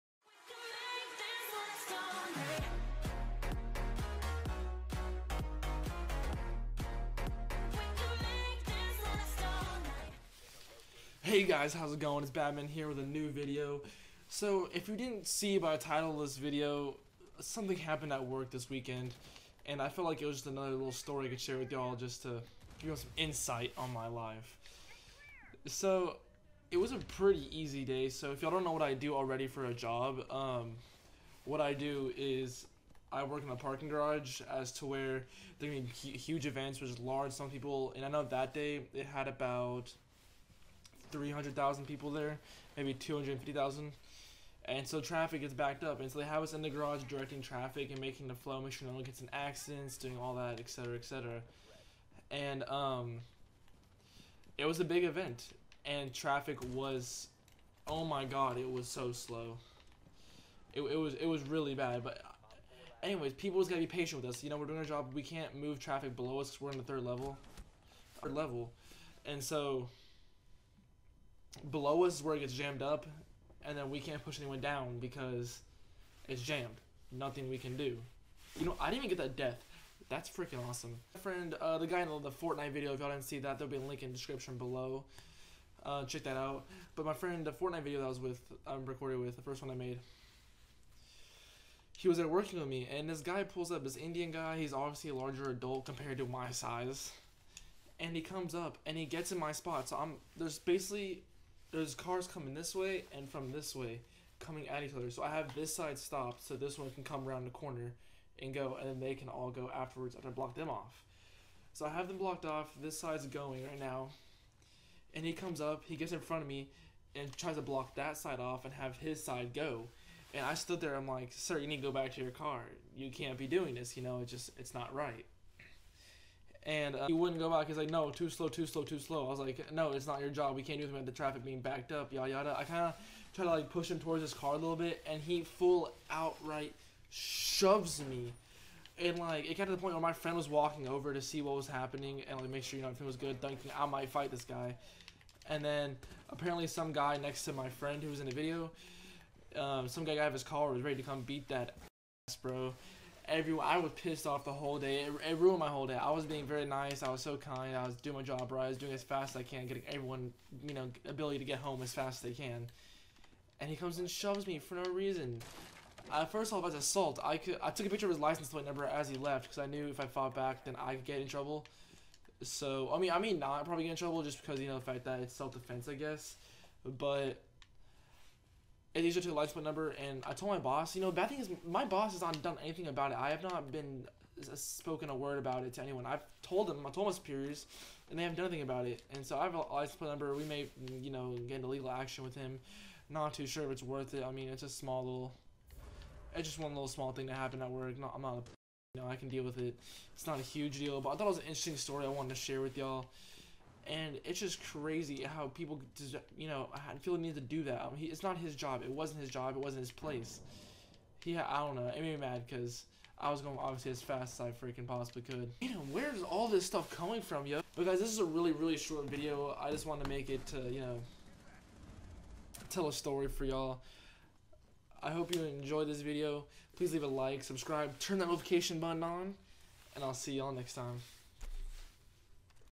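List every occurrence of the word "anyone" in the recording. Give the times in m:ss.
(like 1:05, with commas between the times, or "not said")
1:14, 3:05.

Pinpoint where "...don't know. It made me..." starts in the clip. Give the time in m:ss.
3:31.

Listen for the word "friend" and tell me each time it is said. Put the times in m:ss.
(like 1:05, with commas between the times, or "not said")
1:21, 1:27, 2:20, 2:27.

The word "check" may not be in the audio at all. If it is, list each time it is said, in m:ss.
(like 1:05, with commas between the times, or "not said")
1:26.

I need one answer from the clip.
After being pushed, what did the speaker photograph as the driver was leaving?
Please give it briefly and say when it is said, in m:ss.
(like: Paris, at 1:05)
license plate number, at 2:48.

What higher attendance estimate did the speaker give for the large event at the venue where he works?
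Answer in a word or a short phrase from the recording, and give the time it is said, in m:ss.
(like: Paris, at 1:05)
300,000, at 0:41.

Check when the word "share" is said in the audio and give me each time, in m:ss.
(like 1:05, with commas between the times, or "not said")
0:21, 3:22.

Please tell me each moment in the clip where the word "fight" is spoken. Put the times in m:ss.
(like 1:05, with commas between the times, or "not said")
2:24.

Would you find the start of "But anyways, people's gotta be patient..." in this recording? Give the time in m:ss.
1:02.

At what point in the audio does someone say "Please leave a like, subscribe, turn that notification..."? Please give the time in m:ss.
3:46.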